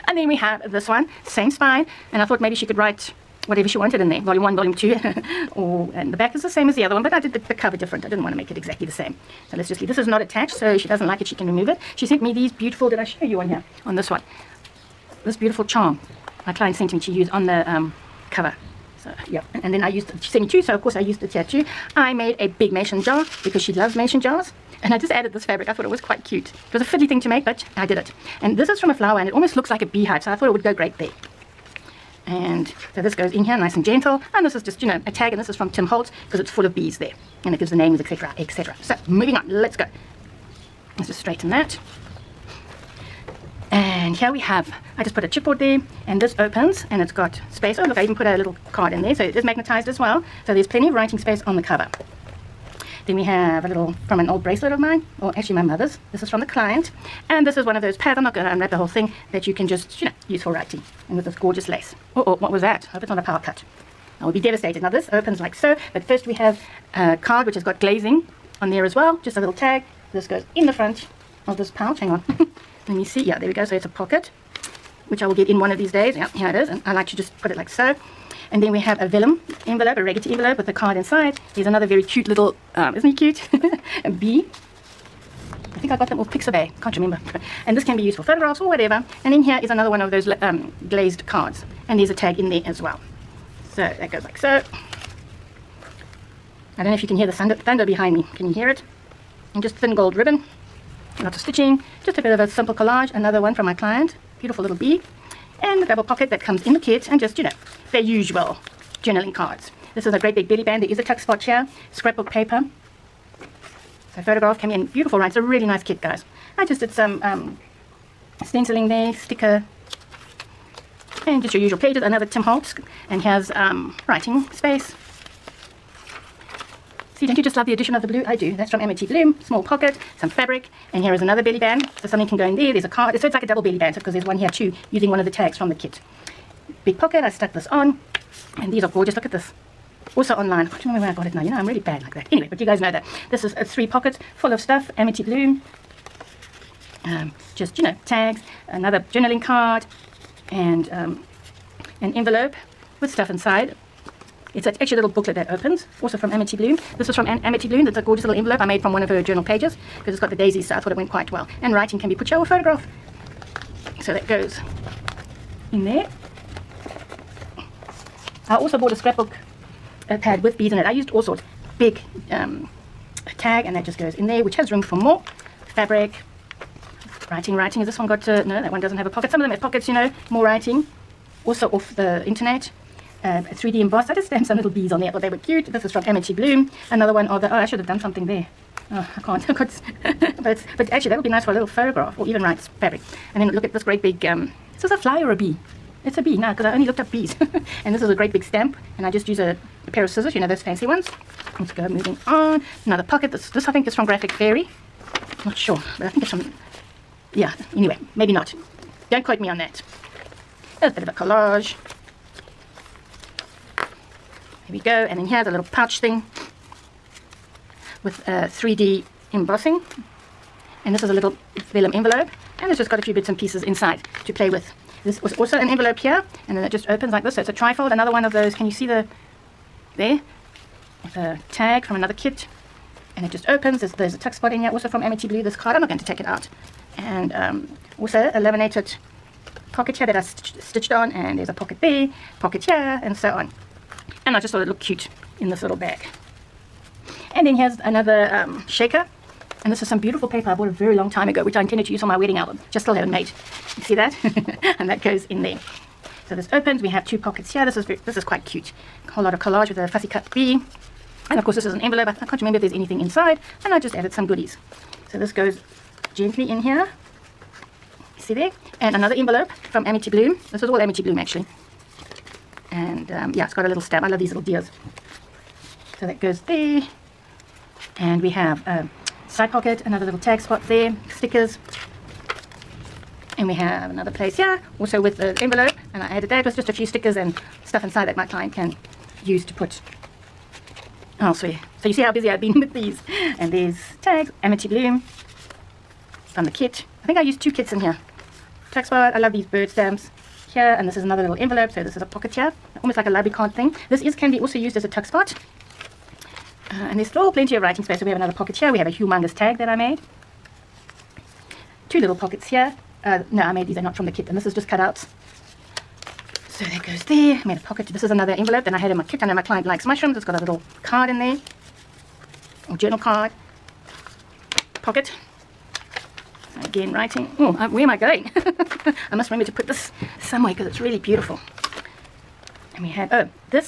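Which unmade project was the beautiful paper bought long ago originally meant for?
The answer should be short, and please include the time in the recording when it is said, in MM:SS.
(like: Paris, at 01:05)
Wedding album, at 04:12.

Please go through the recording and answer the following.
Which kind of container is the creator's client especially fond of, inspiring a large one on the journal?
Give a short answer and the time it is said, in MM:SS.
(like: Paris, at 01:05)
Mason jars, at 00:23.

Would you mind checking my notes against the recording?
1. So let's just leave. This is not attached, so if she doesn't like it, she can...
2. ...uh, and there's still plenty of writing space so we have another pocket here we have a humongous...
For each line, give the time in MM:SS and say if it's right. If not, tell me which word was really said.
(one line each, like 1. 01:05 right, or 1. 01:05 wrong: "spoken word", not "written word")
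1. 00:09 right
2. 05:06 right.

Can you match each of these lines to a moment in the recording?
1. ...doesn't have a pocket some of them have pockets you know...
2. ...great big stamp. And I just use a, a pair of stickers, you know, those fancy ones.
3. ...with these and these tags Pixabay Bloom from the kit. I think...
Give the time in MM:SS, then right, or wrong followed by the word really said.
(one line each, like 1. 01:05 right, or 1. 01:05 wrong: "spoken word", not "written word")
1. 02:58 right
2. 03:18 wrong: "scissors", not "stickers"
3. 04:52 wrong: "Amity", not "Pixabay".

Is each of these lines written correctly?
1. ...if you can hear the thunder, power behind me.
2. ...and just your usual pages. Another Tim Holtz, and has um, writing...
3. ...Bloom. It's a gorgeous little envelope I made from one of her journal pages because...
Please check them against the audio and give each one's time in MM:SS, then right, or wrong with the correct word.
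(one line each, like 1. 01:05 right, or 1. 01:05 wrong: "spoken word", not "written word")
1. 01:36 wrong: "thunder", not "power"
2. 02:01 right
3. 02:37 right.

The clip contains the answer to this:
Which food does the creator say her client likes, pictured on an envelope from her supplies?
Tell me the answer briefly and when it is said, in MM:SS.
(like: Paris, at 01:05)
Mushrooms, at 05:19.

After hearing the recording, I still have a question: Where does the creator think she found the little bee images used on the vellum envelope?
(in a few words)
Pixabay.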